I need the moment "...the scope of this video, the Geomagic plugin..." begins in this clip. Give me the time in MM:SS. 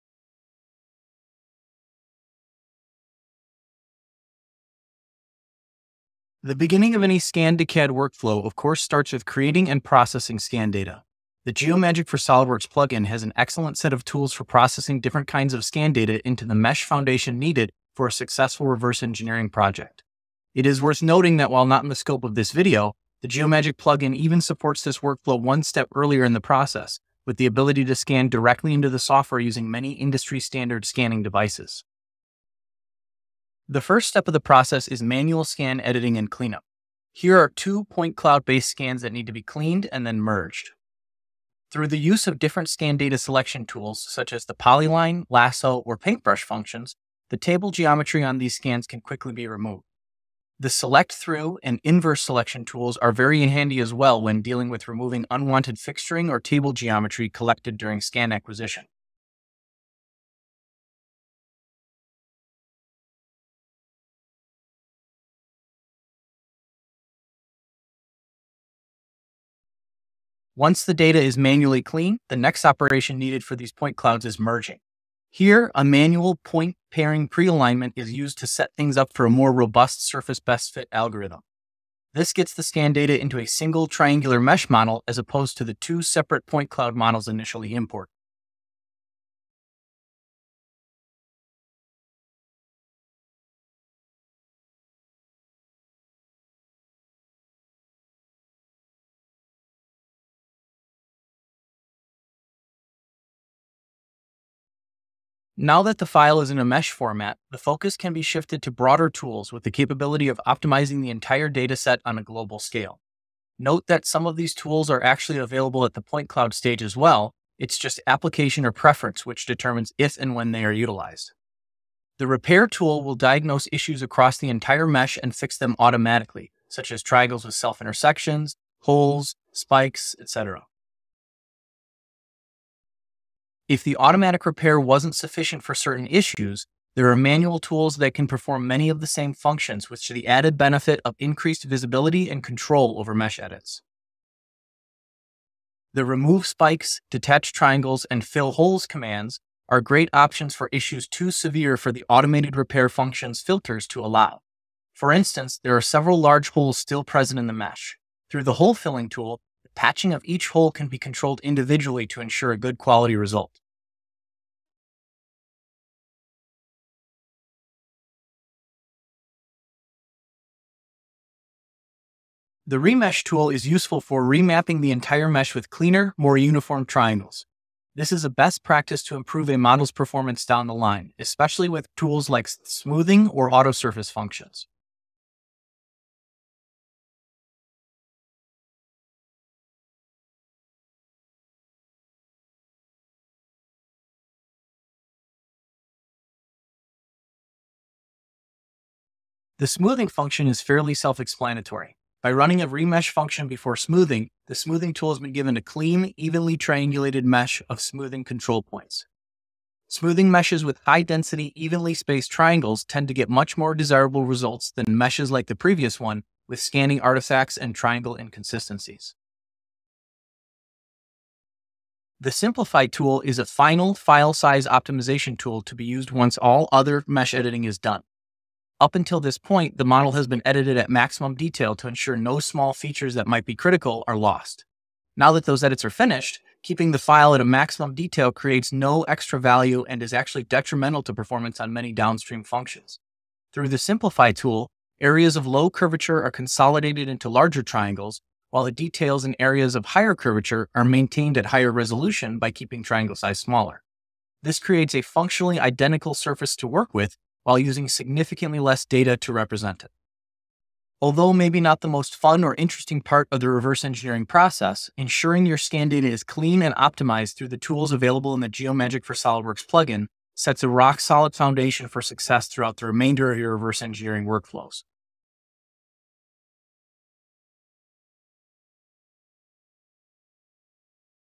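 00:21.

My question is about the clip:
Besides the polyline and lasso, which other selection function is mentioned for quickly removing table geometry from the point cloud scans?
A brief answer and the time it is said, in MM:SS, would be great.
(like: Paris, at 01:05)
paintbrush, at 00:45.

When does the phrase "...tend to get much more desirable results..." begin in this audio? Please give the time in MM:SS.
03:32.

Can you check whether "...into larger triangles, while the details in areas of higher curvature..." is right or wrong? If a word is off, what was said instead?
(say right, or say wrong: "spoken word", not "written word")
right.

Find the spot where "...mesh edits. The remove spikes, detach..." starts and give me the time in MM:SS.
02:23.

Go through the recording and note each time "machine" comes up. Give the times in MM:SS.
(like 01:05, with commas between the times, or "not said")
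not said.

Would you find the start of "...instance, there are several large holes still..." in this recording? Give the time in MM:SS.
02:35.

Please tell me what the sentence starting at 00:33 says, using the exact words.
The first step of the process is manual scan editing and cleanup.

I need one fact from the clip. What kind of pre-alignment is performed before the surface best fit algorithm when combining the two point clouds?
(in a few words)
manual point pairing.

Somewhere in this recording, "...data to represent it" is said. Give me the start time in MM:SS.
04:18.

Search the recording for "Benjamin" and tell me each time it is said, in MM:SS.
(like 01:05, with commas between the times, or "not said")
not said.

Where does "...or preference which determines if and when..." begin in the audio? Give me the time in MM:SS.
01:58.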